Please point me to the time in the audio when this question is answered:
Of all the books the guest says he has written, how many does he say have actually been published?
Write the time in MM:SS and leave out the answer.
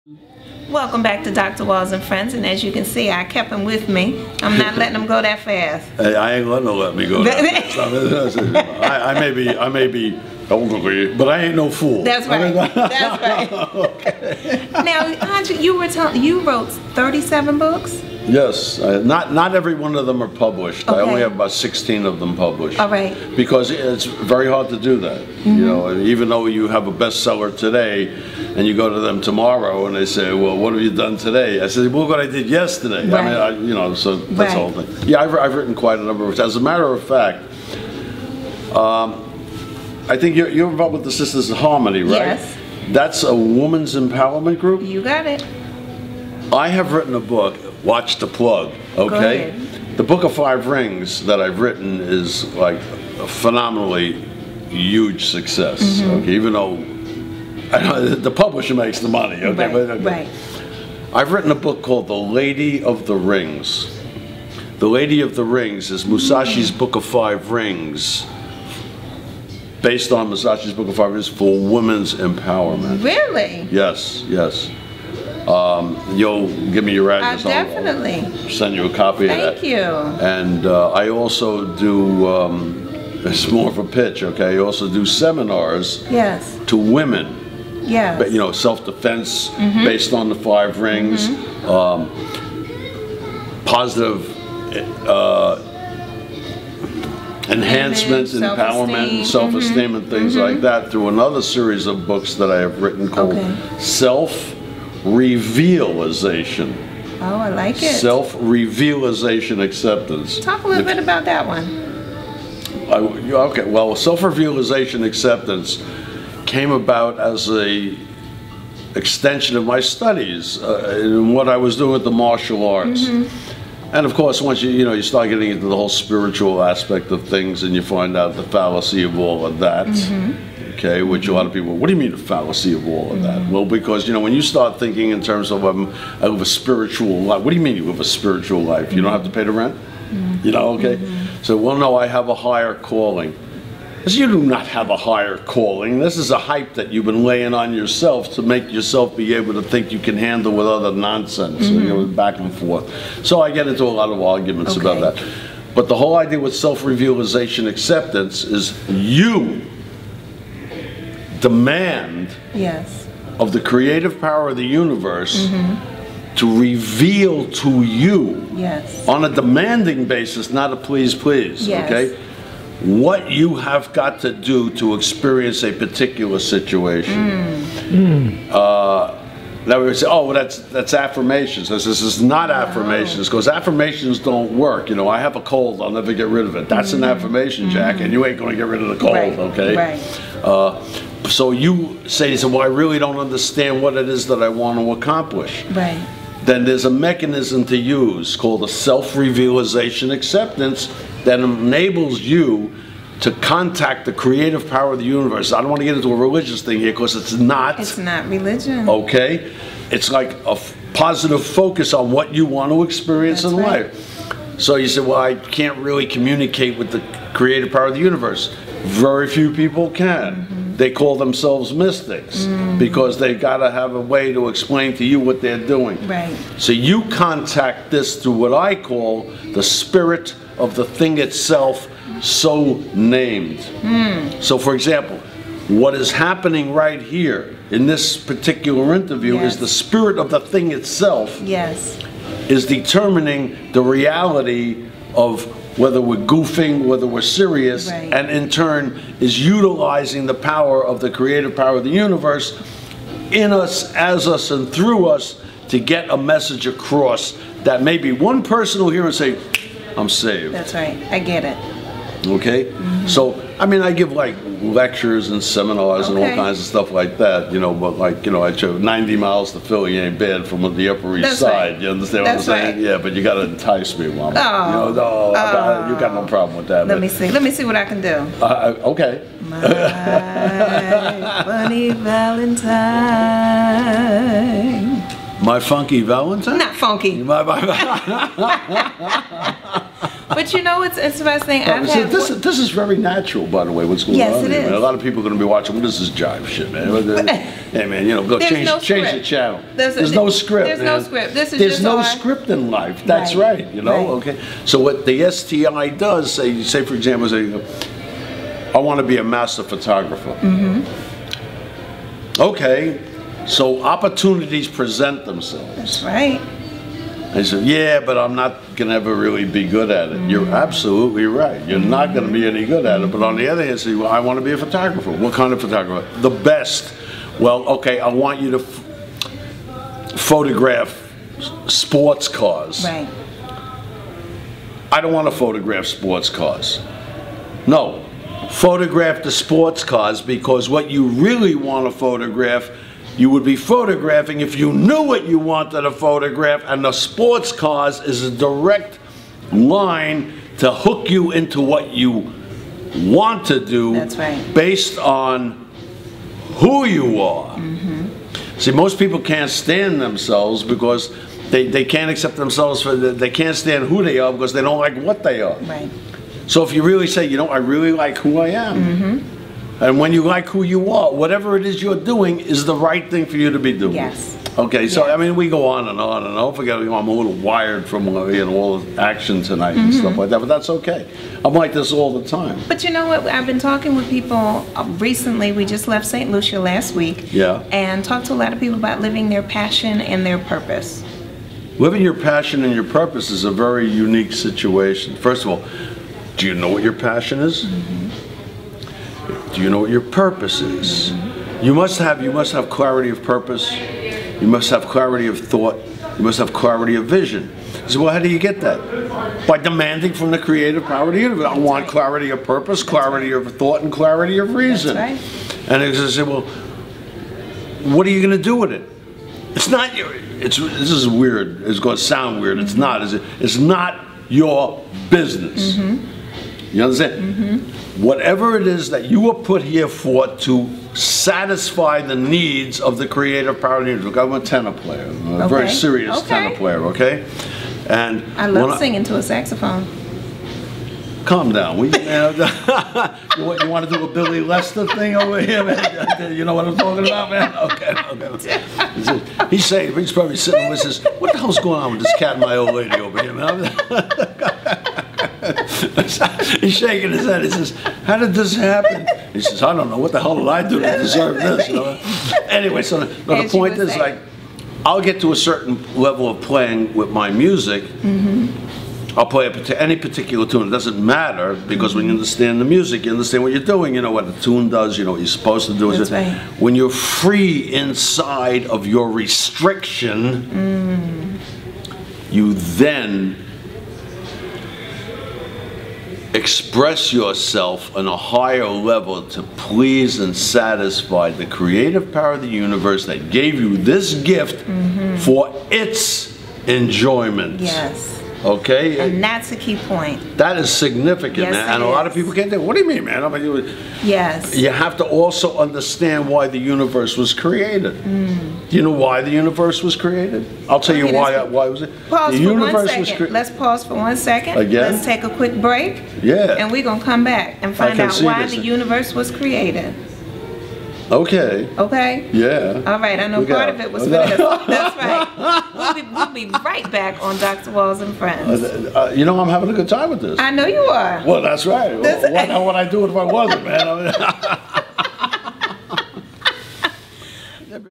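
00:21.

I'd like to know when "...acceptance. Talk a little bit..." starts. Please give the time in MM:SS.
01:49.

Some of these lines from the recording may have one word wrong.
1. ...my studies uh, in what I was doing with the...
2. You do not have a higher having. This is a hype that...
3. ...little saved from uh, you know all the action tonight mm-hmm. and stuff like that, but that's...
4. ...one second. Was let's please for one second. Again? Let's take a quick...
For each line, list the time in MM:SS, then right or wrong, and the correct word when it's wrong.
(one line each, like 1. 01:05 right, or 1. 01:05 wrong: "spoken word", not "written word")
1. 01:59 right
2. 02:24 wrong: "calling", not "having"
3. 06:17 wrong: "wired", not "saved"
4. 08:32 wrong: "pause", not "please".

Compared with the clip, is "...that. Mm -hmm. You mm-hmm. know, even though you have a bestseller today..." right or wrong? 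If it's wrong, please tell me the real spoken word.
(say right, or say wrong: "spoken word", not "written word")
right.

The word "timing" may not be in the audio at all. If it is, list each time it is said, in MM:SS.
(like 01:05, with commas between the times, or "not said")
not said.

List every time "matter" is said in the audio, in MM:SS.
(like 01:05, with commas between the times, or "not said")
00:36, 07:51.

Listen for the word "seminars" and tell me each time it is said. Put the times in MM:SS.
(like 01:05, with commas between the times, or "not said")
01:25, 04:25.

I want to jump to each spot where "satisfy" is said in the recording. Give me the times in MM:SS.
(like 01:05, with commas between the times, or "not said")
07:10, 08:10.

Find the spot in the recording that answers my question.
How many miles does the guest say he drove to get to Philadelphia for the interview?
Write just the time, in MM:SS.
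04:28.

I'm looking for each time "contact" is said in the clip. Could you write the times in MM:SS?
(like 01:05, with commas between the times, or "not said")
03:23, 03:47.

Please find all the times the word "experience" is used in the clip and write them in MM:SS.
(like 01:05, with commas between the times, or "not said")
02:54, 03:32.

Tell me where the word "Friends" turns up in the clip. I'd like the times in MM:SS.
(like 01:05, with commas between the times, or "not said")
00:02, 08:48.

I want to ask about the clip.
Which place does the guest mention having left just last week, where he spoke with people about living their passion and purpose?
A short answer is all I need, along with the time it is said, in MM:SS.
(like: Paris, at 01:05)
St. Lucia, at 06:26.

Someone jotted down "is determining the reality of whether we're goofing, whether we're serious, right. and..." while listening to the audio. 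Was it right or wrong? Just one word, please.
right.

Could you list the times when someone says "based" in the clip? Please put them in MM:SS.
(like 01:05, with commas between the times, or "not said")
01:09, 01:29, 05:54.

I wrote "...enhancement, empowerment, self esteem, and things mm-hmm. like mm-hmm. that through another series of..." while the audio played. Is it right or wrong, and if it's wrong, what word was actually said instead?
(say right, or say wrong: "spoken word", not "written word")
right.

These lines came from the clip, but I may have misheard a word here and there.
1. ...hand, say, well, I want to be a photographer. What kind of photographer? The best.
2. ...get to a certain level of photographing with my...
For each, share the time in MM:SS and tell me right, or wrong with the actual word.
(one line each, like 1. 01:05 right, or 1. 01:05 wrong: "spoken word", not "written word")
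1. 05:23 right
2. 07:45 wrong: "playing", not "photographing".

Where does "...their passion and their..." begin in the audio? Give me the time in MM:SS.
06:29.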